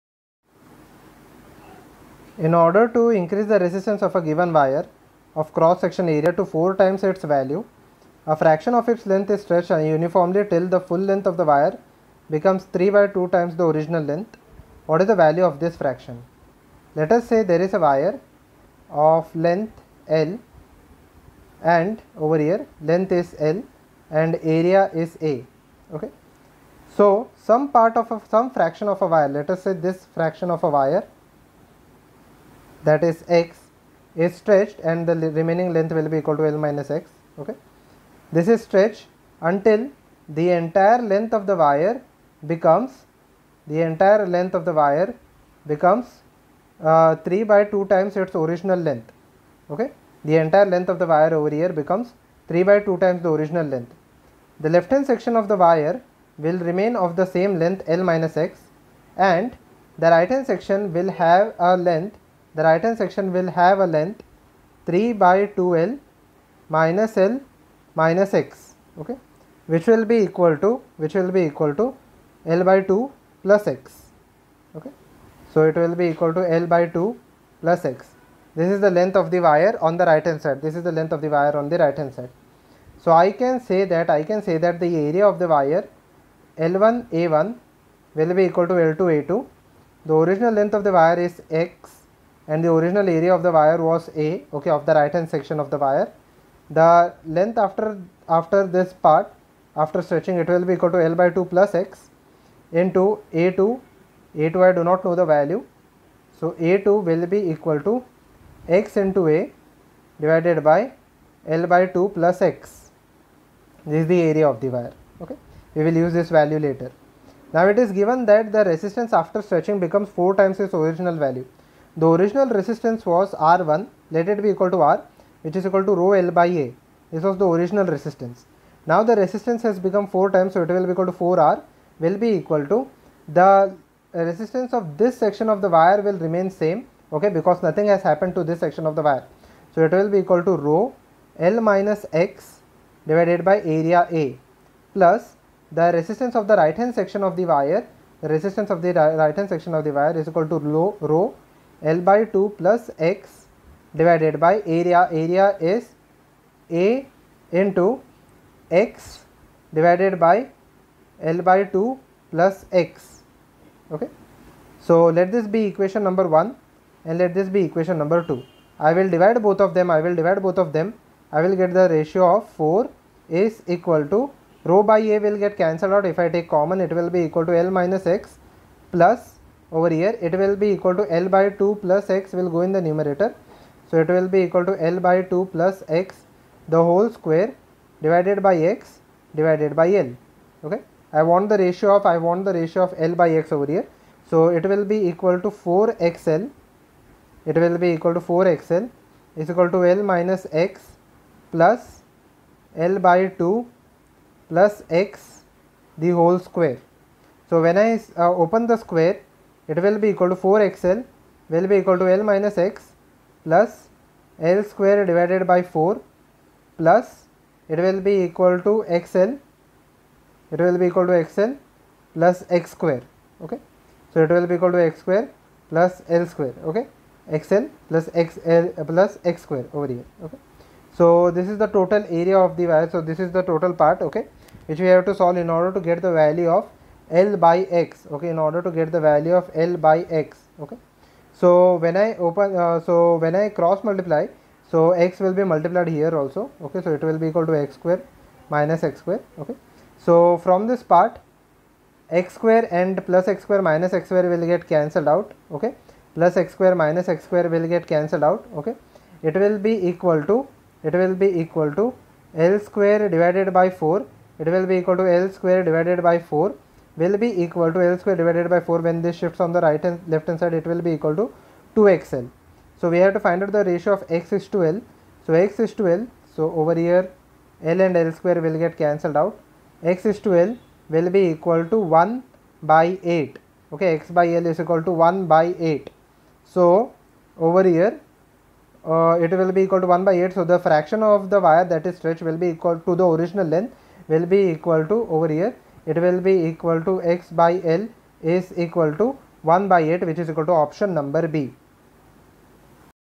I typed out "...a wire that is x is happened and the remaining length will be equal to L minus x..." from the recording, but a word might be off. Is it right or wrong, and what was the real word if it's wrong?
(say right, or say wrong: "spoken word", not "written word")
wrong: "stretched", not "happened".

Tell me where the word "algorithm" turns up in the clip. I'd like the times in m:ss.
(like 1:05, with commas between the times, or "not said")
not said.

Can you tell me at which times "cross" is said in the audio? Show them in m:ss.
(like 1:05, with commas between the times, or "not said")
0:05, 4:03.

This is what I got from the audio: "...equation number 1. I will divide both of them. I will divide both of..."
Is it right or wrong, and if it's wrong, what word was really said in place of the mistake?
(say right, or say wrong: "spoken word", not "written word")
wrong: "2", not "1".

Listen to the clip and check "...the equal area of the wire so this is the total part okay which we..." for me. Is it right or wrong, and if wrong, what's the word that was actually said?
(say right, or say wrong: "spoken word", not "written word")
wrong: "total", not "equal".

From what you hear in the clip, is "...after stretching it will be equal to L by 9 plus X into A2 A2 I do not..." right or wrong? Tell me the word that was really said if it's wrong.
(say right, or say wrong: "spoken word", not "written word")
wrong: "2", not "9".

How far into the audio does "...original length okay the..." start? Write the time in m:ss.
0:48.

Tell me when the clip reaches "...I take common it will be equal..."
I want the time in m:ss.
2:56.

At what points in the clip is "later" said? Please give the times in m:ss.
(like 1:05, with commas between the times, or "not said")
1:56.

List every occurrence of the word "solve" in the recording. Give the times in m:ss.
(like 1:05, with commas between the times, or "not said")
3:55.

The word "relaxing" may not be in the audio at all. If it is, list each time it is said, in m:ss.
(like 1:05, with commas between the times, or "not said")
not said.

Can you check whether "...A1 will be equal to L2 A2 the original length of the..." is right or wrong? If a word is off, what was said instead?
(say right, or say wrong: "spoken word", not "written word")
right.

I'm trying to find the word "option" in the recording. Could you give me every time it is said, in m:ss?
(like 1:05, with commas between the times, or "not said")
5:00.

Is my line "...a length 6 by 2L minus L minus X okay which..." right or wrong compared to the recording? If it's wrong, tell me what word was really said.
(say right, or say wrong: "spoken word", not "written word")
wrong: "3", not "6".